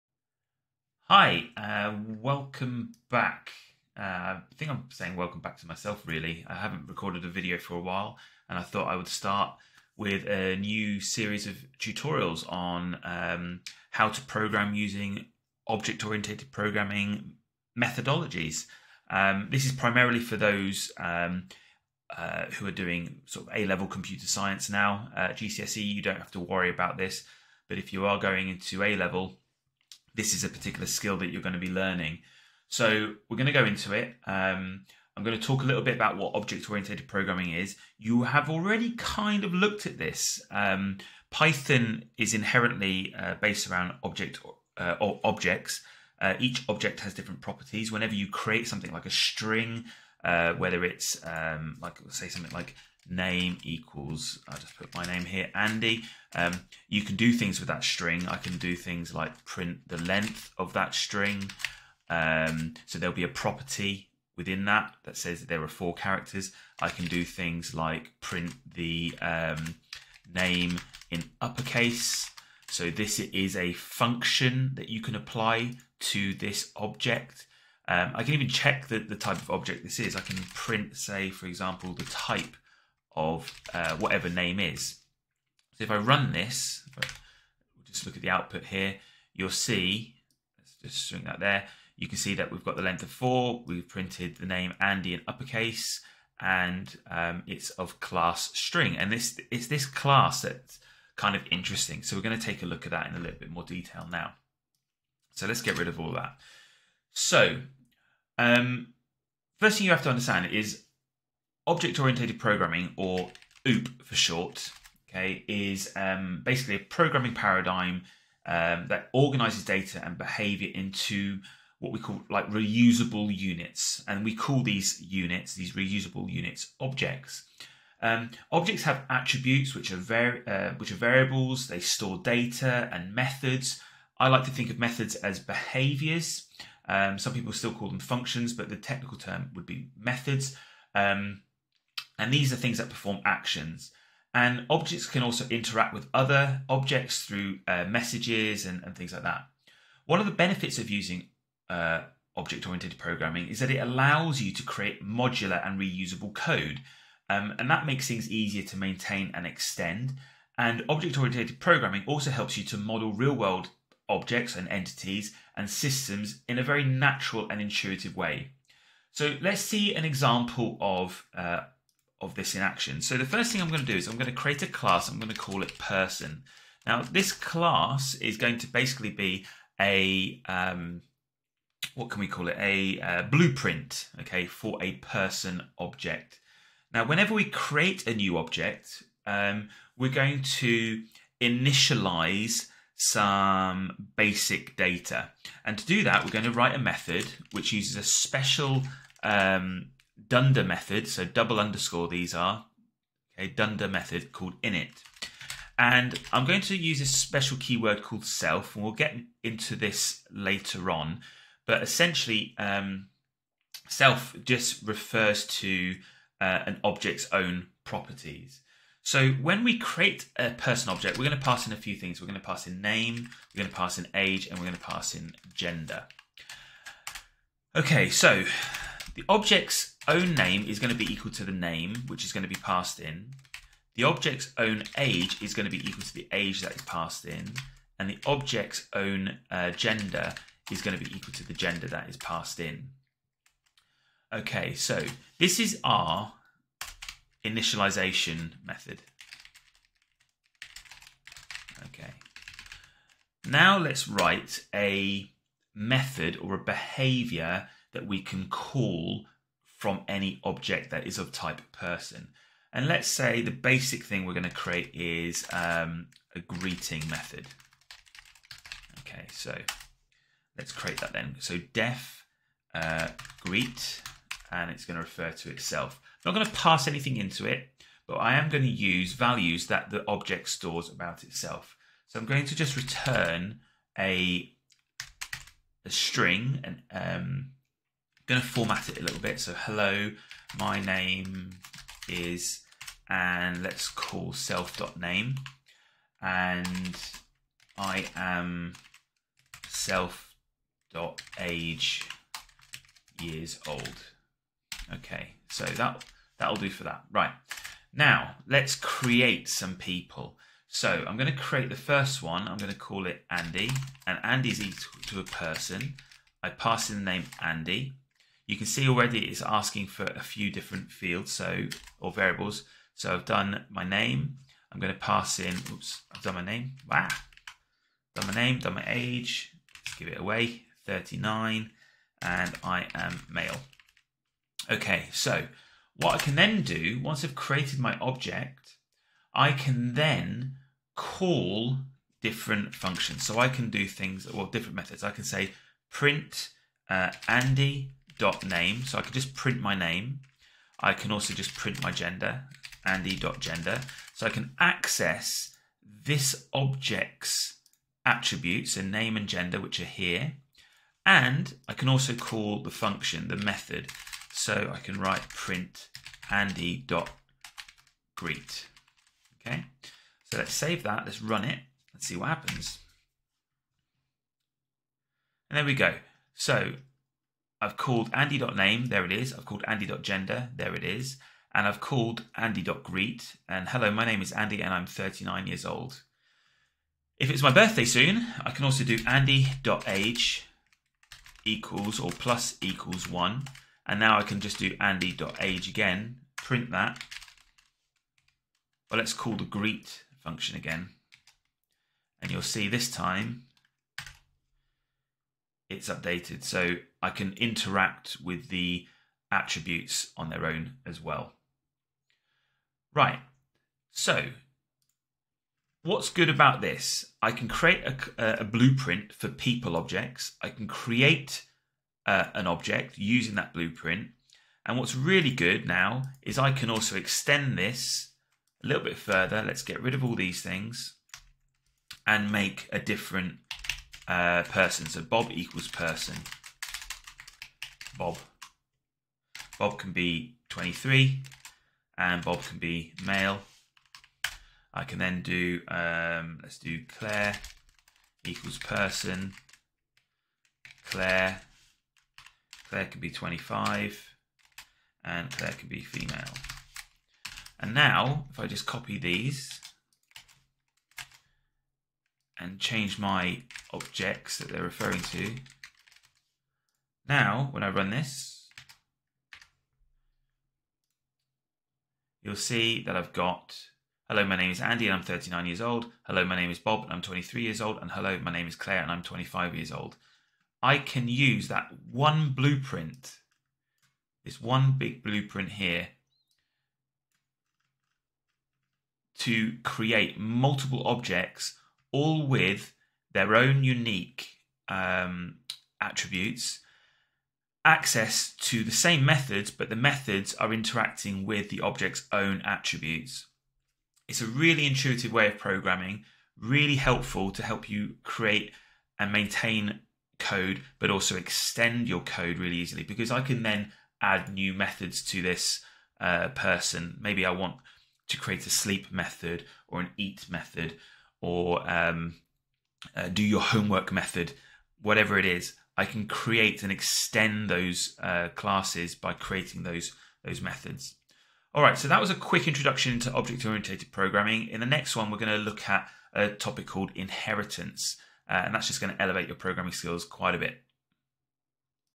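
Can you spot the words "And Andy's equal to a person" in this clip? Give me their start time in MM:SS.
05:14.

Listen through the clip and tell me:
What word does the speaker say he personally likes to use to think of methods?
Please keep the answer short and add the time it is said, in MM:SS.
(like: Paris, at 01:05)
behaviors, at 02:15.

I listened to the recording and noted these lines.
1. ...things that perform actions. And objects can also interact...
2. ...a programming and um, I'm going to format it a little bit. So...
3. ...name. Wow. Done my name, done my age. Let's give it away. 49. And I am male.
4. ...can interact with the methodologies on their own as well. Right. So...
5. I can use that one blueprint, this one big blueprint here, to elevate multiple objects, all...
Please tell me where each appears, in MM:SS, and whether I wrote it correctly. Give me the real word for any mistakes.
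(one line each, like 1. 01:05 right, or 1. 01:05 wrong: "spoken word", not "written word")
1. 02:22 right
2. 04:45 wrong: "string", not "programming"
3. 05:26 wrong: "39", not "49"
4. 06:47 wrong: "attributes", not "methodologies"
5. 08:00 wrong: "create", not "elevate".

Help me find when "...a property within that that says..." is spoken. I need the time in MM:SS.
01:03.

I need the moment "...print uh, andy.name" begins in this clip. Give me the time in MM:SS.
05:45.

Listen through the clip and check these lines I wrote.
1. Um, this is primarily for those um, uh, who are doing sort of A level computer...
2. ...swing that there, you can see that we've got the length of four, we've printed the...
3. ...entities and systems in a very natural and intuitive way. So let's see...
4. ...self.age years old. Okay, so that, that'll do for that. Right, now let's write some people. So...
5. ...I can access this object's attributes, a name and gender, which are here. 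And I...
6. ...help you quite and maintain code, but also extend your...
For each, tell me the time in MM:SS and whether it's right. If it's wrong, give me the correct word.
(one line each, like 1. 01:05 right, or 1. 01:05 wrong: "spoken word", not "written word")
1. 00:19 right
2. 01:31 right
3. 02:44 right
4. 04:59 wrong: "create", not "write"
5. 05:54 right
6. 08:27 wrong: "create", not "quite".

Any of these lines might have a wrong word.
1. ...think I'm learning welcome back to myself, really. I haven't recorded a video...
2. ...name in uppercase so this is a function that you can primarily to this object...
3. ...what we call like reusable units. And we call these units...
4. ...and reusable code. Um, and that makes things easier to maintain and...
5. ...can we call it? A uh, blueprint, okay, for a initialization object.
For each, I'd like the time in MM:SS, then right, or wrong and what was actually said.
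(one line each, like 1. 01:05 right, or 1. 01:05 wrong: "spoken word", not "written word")
1. 00:04 wrong: "saying", not "learning"
2. 01:10 wrong: "apply", not "primarily"
3. 02:01 right
4. 02:35 right
5. 03:02 wrong: "person", not "initialization".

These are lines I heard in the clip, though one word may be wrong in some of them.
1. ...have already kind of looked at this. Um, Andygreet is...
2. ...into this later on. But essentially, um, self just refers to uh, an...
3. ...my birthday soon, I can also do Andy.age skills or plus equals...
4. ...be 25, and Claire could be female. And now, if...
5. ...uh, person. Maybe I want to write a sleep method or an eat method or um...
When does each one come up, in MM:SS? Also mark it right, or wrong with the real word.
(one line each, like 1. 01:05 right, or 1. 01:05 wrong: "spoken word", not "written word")
1. 00:38 wrong: "Python", not "Andygreet"
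2. 03:29 right
3. 06:27 wrong: "equals", not "skills"
4. 07:33 right
5. 08:35 wrong: "create", not "write".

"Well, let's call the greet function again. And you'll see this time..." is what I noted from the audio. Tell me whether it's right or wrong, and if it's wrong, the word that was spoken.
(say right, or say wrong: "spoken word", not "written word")
right.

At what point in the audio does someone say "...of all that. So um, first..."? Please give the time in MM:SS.
01:45.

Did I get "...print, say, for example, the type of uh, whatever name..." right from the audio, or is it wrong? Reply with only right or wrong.
right.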